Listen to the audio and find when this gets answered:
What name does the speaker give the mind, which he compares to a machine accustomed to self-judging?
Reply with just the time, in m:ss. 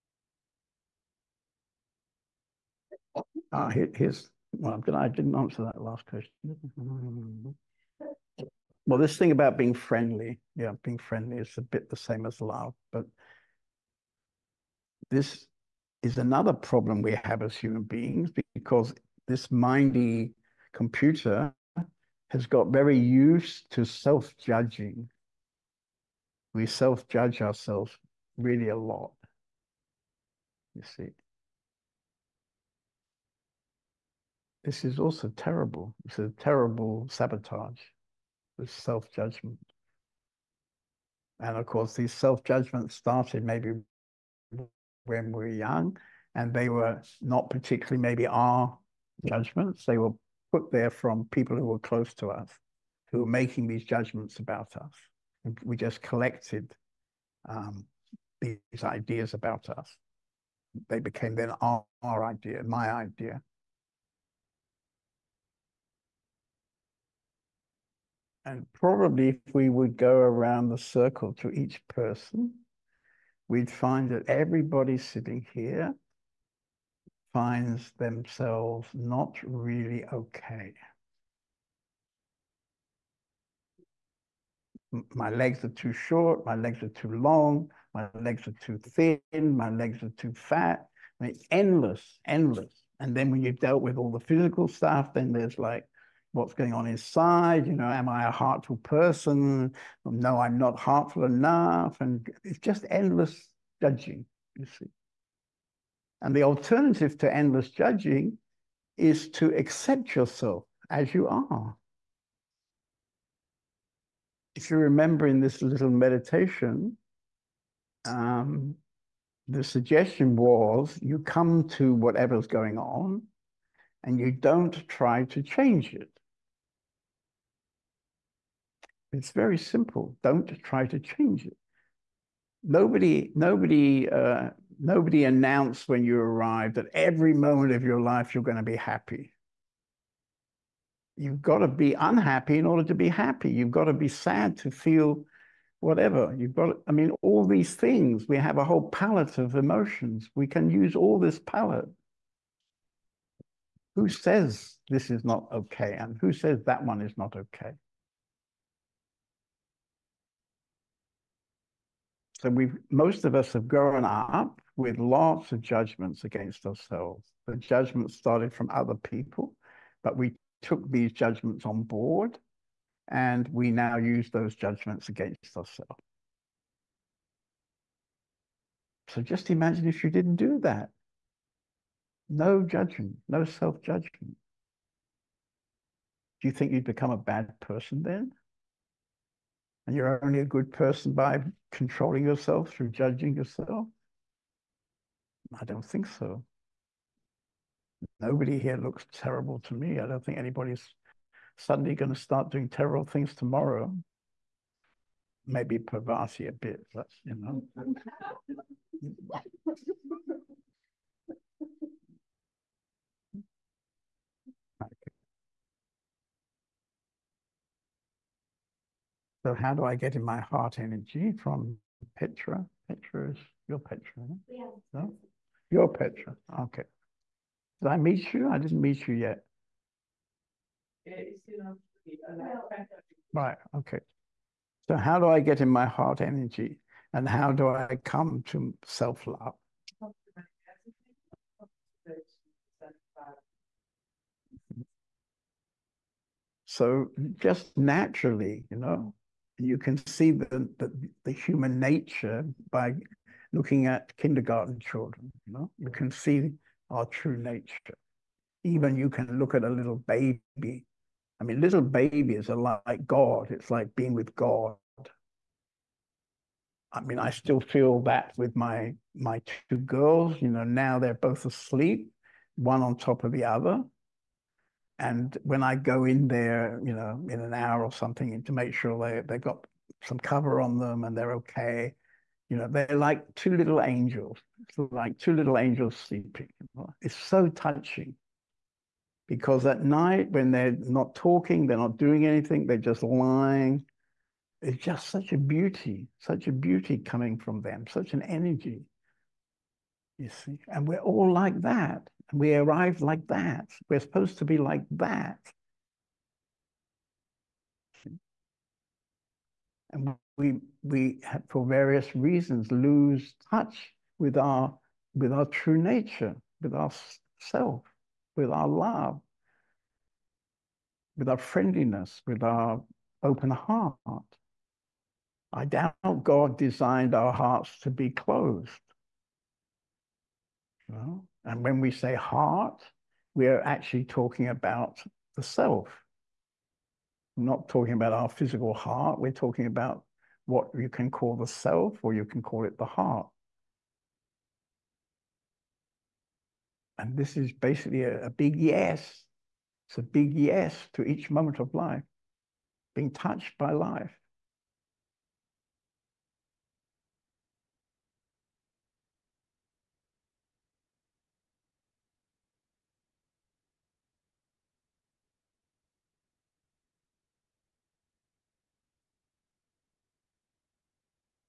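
0:19.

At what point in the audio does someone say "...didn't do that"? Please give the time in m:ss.
3:00.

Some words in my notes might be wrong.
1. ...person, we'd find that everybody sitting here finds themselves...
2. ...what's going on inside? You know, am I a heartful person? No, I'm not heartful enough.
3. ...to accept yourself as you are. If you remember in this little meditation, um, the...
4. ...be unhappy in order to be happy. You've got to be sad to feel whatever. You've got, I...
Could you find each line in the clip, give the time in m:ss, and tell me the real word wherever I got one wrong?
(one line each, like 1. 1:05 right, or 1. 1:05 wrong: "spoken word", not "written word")
1. 1:11 right
2. 1:36 right
3. 1:49 right
4. 2:21 right.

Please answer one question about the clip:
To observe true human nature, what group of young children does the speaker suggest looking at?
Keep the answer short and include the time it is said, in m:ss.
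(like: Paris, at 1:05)
kindergarten children, at 4:14.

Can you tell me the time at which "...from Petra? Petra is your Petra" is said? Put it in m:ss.
3:41.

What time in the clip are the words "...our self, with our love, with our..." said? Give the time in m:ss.
5:16.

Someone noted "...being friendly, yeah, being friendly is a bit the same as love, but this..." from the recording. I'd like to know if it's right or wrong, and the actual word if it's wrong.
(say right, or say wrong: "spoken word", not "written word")
right.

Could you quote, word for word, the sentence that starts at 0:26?
We self judge ourselves really a lot, you see.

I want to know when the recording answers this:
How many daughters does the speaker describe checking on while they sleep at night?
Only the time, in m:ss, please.
4:29.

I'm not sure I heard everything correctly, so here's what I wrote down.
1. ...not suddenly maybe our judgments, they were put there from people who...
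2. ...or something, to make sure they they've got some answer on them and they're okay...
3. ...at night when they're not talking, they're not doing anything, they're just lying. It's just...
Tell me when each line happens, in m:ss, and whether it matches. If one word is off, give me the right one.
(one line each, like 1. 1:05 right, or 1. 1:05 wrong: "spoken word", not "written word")
1. 0:47 wrong: "particularly", not "suddenly"
2. 4:37 wrong: "cover", not "answer"
3. 4:49 right.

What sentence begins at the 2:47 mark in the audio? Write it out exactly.
The judgments started from other people, but we took these judgments on board and we now use those judgments against ourselves.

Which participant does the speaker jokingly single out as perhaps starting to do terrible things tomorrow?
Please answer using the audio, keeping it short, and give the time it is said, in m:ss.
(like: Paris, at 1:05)
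Parvati, at 3:25.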